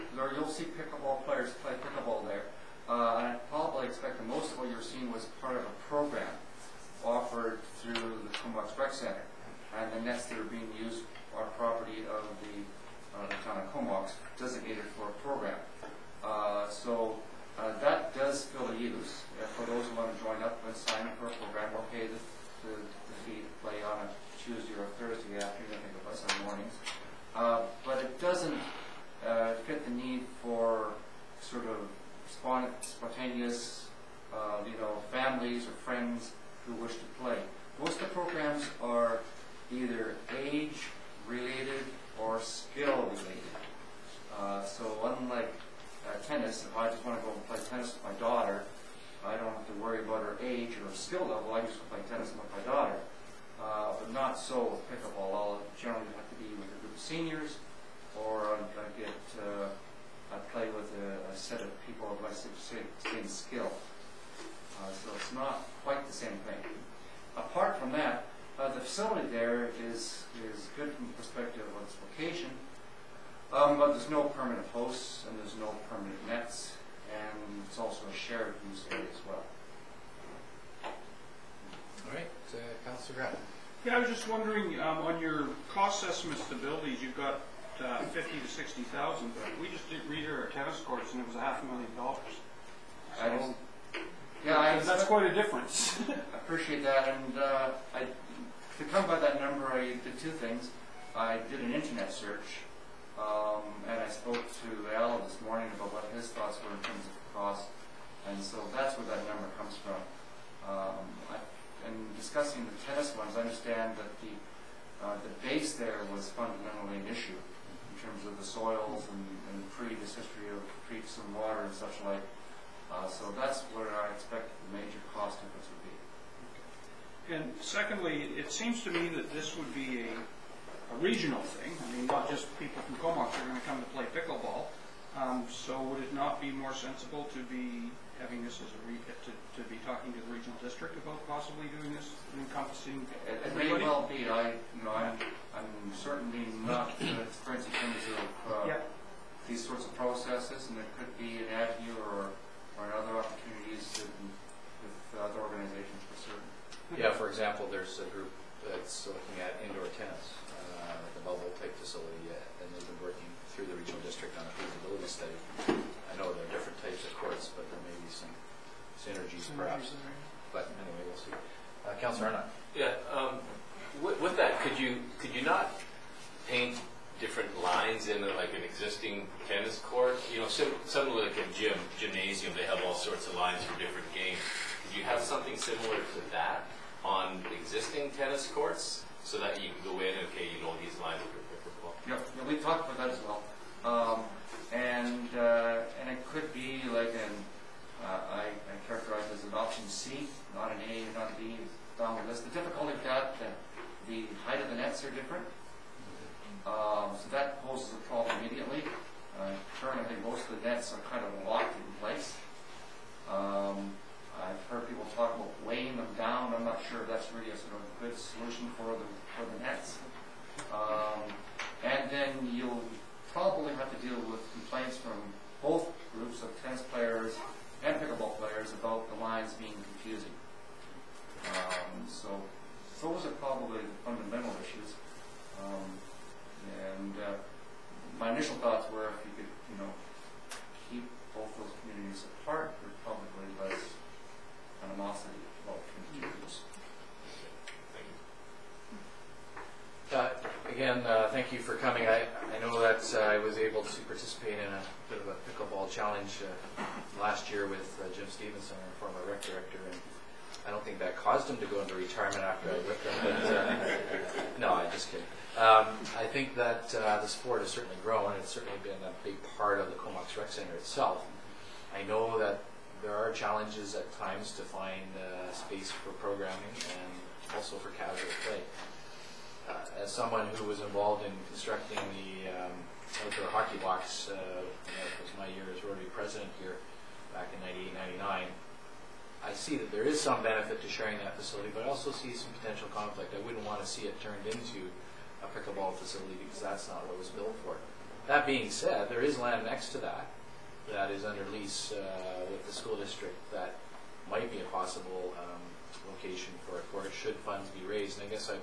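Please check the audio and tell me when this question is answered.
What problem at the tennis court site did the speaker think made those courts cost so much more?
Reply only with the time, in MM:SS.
01:58.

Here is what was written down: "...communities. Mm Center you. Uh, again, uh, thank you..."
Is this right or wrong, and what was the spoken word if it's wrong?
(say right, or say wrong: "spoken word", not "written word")
wrong: "Thank", not "Center".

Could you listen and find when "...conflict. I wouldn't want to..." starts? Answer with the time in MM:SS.
04:52.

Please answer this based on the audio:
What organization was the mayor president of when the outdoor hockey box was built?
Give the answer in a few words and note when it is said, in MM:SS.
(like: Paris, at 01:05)
Rotary, at 04:45.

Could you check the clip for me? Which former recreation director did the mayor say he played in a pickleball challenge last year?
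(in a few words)
Jim Stevenson.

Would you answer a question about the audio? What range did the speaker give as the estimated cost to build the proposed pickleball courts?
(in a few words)
50 to 60,000.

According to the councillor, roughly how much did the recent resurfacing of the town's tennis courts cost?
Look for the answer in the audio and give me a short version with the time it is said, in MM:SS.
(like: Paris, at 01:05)
half a million dollars, at 01:31.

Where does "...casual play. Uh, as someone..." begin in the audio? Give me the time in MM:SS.
04:37.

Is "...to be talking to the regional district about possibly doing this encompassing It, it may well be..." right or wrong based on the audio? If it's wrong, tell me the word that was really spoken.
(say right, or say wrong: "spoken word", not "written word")
right.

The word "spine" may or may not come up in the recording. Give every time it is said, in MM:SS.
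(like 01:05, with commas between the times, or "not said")
not said.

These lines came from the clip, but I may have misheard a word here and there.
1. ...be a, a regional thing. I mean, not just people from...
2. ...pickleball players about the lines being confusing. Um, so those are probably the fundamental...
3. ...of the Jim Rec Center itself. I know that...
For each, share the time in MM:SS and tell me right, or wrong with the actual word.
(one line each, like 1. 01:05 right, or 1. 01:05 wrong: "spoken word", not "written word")
1. 02:09 right
2. 03:48 right
3. 04:29 wrong: "Comox", not "Jim".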